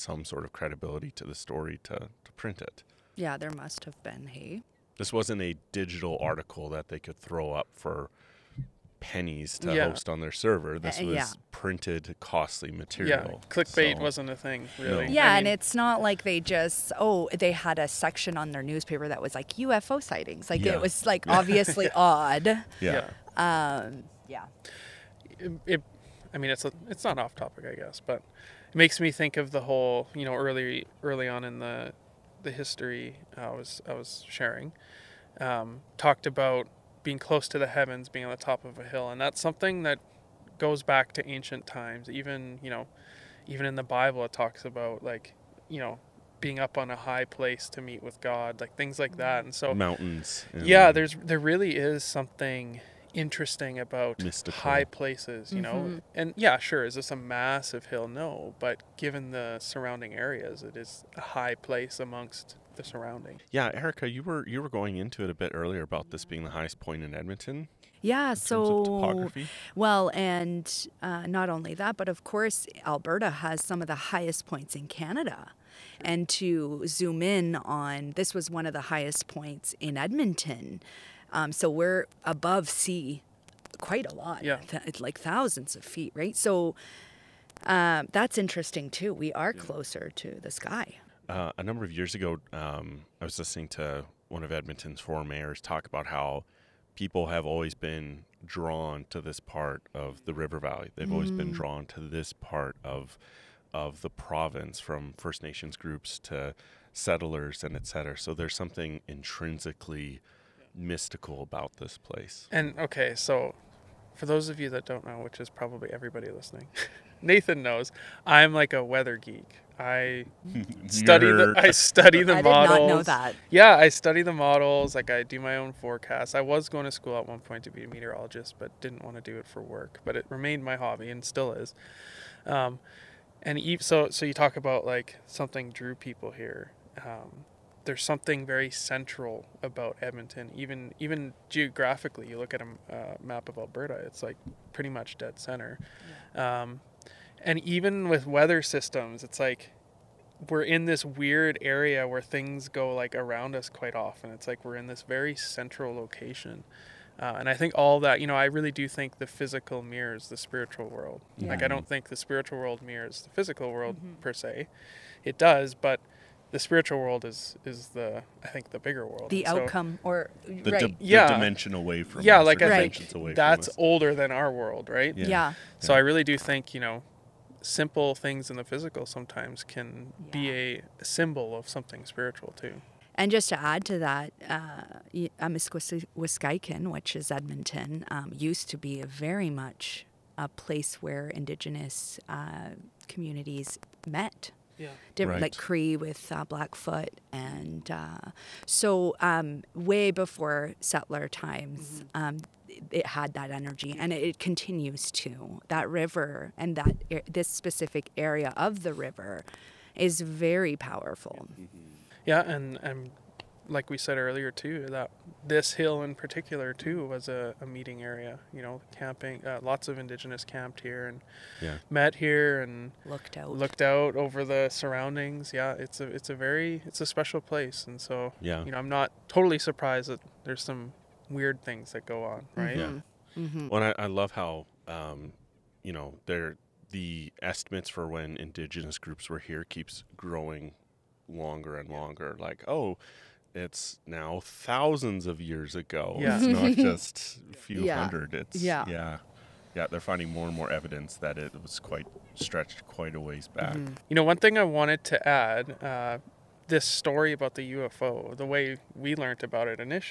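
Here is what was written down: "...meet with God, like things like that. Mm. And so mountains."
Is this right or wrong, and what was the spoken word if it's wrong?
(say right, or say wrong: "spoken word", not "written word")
right.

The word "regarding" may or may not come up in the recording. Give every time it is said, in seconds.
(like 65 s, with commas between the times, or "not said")
not said.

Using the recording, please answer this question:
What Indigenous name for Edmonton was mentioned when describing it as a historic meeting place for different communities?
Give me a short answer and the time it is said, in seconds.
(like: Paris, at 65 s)
Amiskwiskaikan, at 185 s.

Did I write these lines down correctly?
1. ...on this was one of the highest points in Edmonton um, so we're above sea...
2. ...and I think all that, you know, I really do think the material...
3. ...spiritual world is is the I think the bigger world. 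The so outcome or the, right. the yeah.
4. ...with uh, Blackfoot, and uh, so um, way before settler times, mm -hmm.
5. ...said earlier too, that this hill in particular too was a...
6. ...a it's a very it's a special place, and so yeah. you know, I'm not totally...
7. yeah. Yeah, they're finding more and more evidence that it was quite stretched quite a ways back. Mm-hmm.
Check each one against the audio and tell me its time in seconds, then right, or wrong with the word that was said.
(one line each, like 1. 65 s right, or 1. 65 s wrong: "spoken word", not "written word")
1. 77 s right
2. 157 s wrong: "physical", not "material"
3. 166 s right
4. 195 s right
5. 213 s right
6. 226 s right
7. 248 s right.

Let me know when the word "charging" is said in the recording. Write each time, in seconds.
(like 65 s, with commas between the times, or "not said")
not said.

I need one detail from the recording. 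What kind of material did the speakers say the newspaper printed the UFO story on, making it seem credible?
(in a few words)
printed, costly material.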